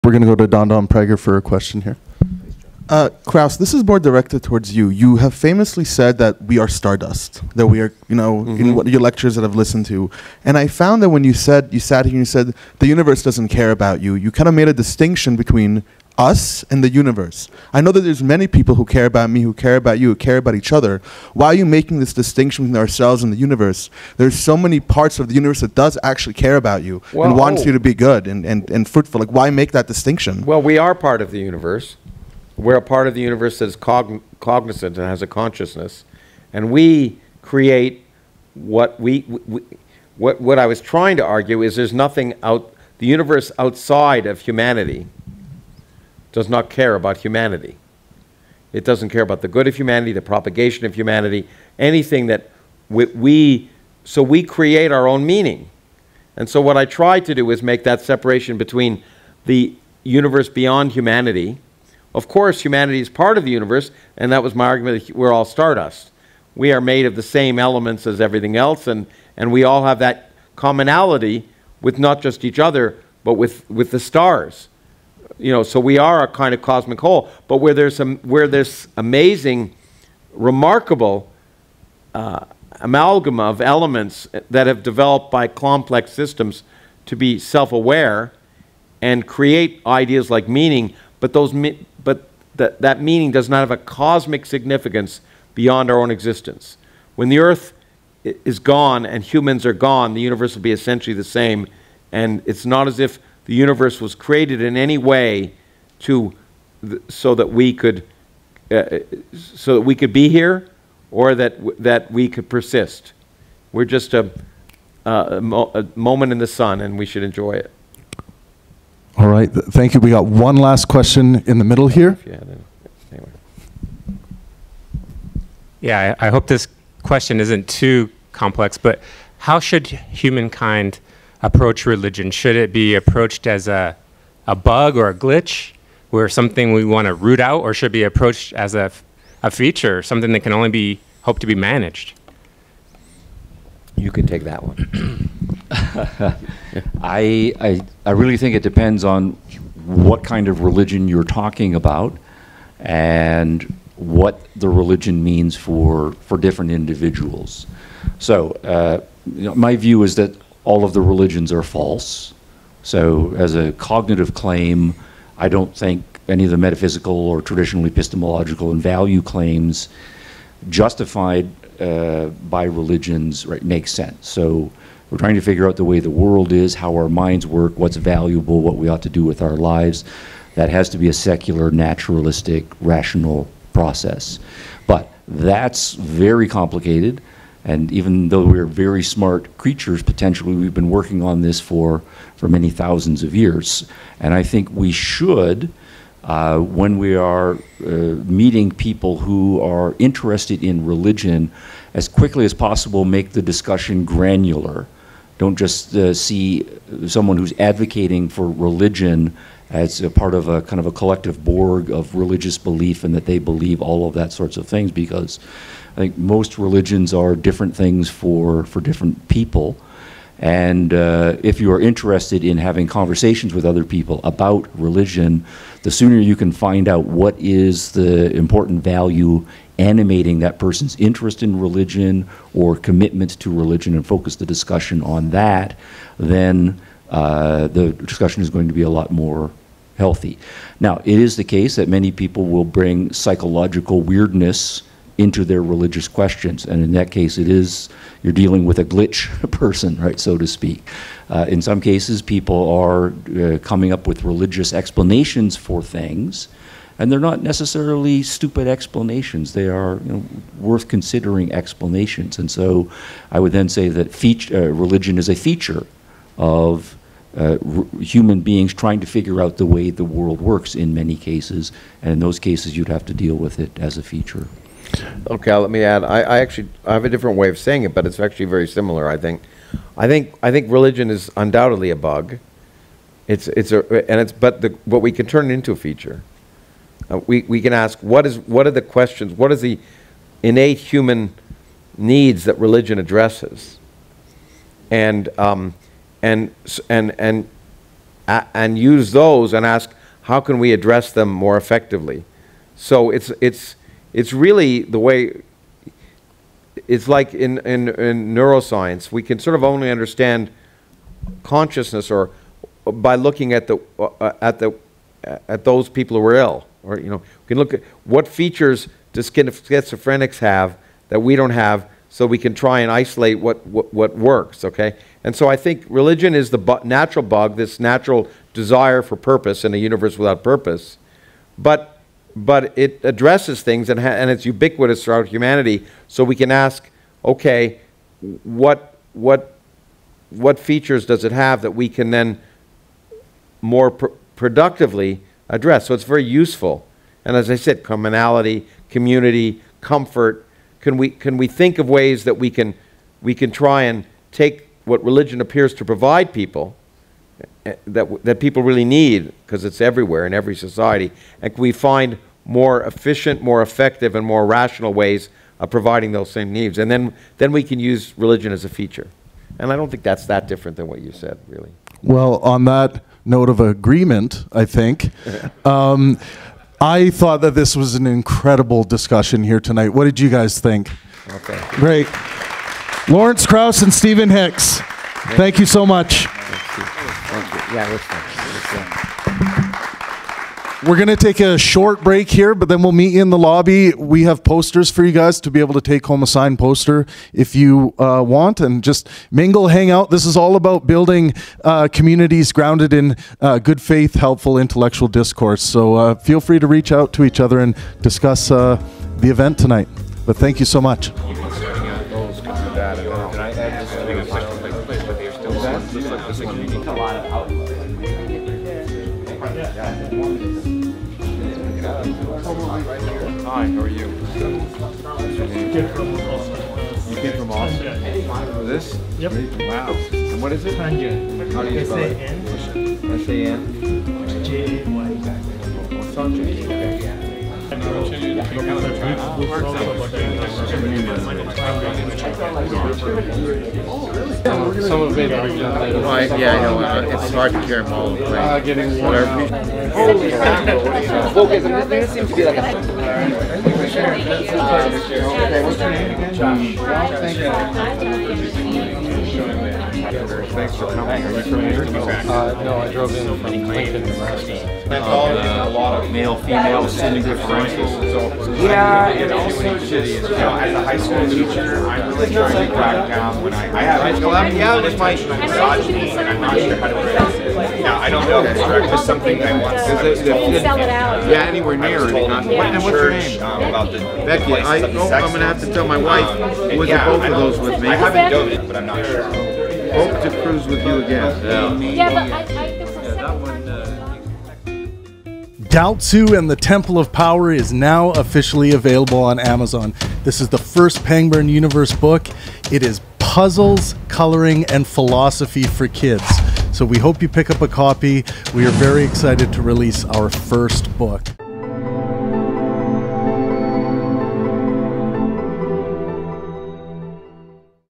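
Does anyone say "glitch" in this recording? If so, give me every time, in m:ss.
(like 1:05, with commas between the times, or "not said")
2:15, 4:08.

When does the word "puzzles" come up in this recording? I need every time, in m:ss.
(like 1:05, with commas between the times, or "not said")
8:23.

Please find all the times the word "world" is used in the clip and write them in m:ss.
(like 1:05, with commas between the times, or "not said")
2:56, 4:30.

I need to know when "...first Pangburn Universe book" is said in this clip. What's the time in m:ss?
8:20.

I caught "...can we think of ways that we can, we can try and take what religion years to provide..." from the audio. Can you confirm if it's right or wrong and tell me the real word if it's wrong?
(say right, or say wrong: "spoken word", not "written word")
wrong: "appears", not "years".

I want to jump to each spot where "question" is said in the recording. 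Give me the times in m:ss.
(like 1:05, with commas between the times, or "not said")
0:01, 2:00, 2:07, 4:06, 4:48.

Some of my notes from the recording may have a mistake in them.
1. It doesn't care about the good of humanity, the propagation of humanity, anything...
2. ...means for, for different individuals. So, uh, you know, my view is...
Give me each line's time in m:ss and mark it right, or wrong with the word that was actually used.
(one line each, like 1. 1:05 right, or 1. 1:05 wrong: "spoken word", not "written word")
1. 0:48 right
2. 2:35 right.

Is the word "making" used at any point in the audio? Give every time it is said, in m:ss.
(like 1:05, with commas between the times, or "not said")
0:21.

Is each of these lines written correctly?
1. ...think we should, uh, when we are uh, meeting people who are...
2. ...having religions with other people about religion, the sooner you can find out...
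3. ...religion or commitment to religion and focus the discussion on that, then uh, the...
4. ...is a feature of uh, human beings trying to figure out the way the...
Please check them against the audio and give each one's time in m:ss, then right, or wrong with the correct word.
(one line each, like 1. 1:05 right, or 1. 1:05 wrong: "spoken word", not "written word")
1. 3:14 right
2. 3:42 wrong: "conversations", not "religions"
3. 3:51 right
4. 4:25 right.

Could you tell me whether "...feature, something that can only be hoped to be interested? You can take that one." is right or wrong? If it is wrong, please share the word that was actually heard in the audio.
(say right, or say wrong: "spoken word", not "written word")
wrong: "managed", not "interested".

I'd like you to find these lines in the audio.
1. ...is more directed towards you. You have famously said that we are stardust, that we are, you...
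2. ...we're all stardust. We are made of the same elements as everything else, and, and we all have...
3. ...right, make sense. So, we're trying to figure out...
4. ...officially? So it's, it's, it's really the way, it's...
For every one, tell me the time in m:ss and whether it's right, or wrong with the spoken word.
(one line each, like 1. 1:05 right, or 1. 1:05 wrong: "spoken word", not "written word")
1. 0:03 right
2. 1:05 right
3. 2:53 right
4. 5:01 wrong: "effectively", not "officially".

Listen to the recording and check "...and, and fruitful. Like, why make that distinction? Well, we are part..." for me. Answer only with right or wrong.
right.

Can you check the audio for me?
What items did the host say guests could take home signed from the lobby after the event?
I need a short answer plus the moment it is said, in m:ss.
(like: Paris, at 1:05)
posters, at 6:34.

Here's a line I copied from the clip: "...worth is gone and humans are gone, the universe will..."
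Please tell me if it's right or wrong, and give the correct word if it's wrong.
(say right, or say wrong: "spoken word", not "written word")
wrong: "earth", not "worth".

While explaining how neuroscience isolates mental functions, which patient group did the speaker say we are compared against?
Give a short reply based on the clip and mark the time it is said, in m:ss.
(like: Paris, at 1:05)
schizophrenics, at 5:19.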